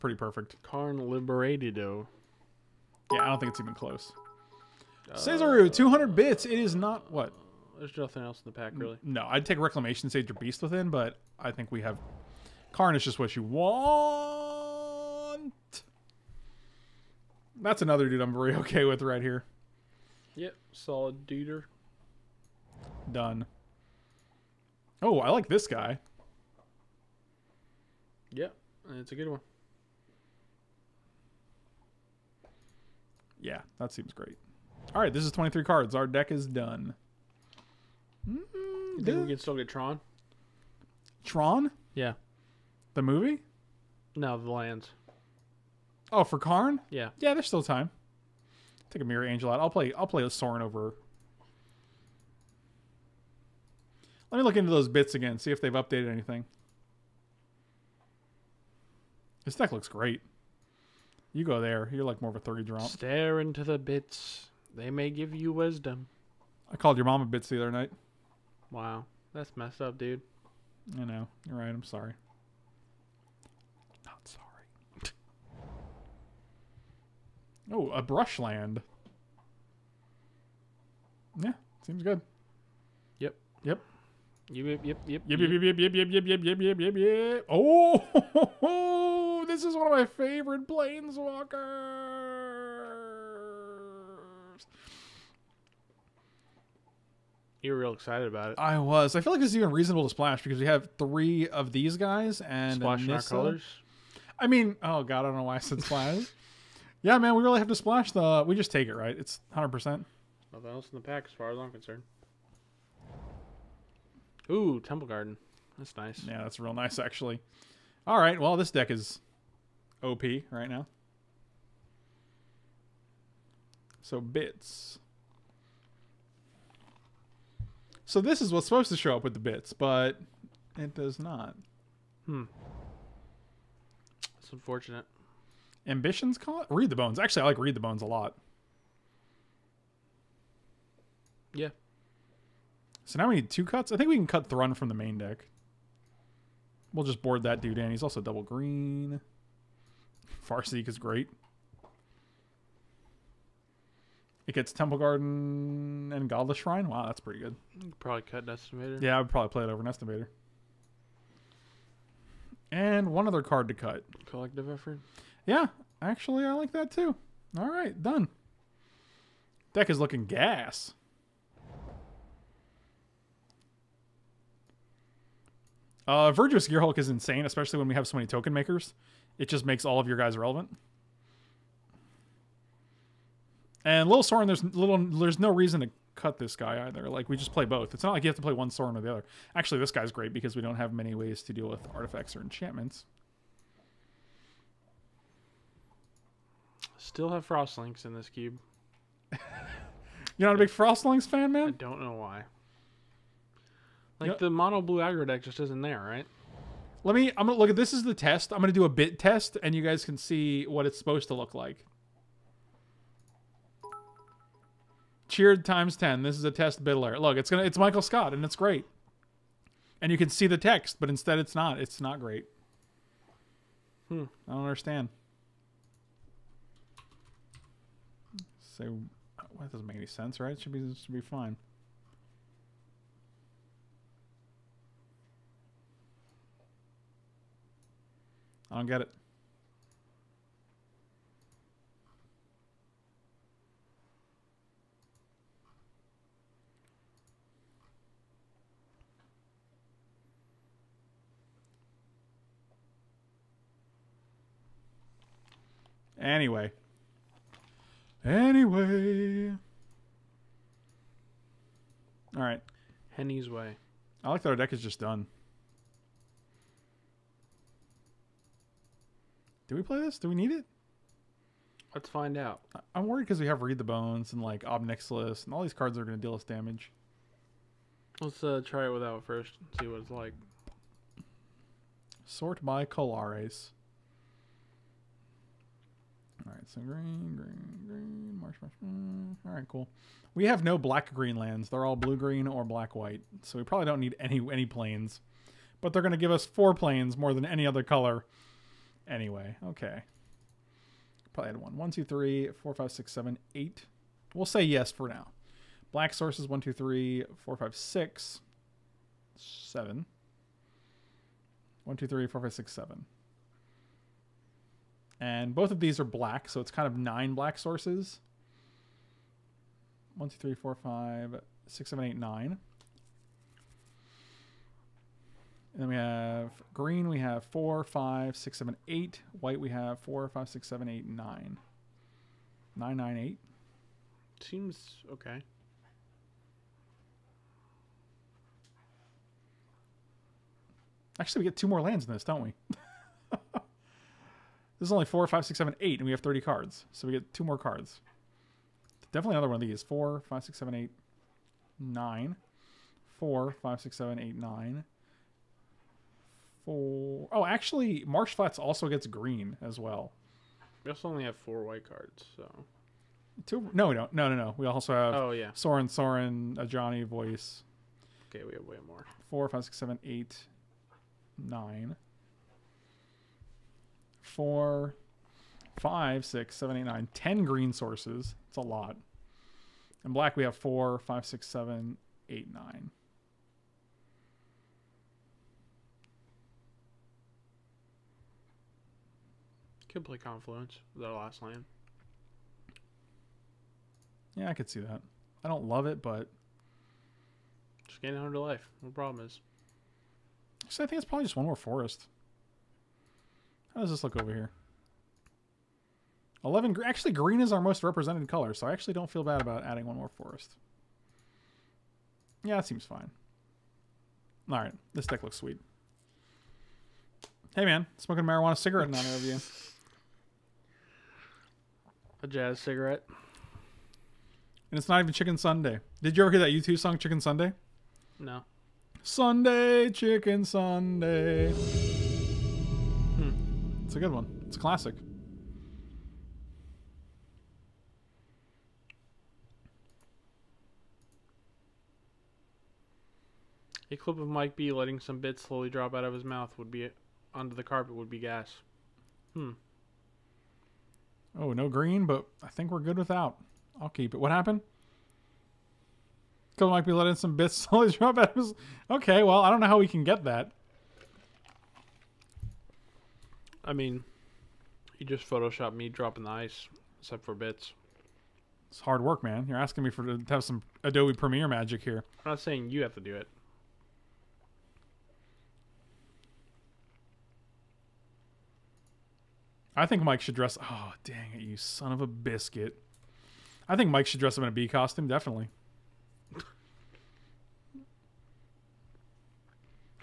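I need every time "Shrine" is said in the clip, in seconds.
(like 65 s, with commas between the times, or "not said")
156 s.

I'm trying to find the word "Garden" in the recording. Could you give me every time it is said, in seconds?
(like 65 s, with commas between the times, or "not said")
115 s, 154 s.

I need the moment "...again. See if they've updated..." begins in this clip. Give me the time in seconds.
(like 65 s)
55 s.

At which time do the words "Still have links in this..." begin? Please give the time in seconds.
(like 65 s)
197 s.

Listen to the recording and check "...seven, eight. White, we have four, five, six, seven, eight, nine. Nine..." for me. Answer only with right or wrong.
right.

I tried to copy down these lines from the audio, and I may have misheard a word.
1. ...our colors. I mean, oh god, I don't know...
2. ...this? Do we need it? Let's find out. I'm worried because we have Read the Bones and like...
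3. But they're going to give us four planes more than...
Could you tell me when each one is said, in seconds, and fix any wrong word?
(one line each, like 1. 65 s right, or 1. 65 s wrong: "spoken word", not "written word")
1. 103 s right
2. 269 s right
3. 295 s right.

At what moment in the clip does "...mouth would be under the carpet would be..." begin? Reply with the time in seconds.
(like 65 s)
446 s.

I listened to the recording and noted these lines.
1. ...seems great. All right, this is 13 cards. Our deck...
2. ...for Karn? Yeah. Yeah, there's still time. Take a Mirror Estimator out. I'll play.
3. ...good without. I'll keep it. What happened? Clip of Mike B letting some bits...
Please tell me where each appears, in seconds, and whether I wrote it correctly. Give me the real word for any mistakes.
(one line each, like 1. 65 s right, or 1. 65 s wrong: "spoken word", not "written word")
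1. 33 s wrong: "23", not "13"
2. 46 s wrong: "Angel", not "Estimator"
3. 452 s right.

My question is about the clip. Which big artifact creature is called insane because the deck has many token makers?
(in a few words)
Verdurous Gearhulk.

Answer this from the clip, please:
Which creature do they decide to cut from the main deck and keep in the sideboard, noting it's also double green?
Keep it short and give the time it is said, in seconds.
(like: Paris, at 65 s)
Thrun, at 144 s.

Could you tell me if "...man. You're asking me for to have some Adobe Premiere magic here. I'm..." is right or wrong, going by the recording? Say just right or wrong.
right.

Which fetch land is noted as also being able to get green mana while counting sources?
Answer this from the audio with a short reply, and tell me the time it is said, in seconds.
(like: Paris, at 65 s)
Marsh Flats, at 358 s.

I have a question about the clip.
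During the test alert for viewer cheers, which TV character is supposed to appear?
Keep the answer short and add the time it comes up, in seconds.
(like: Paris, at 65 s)
Michael Scott, at 217 s.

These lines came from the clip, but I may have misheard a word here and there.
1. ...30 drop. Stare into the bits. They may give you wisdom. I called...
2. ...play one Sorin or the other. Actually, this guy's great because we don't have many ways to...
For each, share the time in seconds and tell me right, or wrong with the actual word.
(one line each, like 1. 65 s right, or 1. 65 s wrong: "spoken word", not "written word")
1. 62 s right
2. 188 s right.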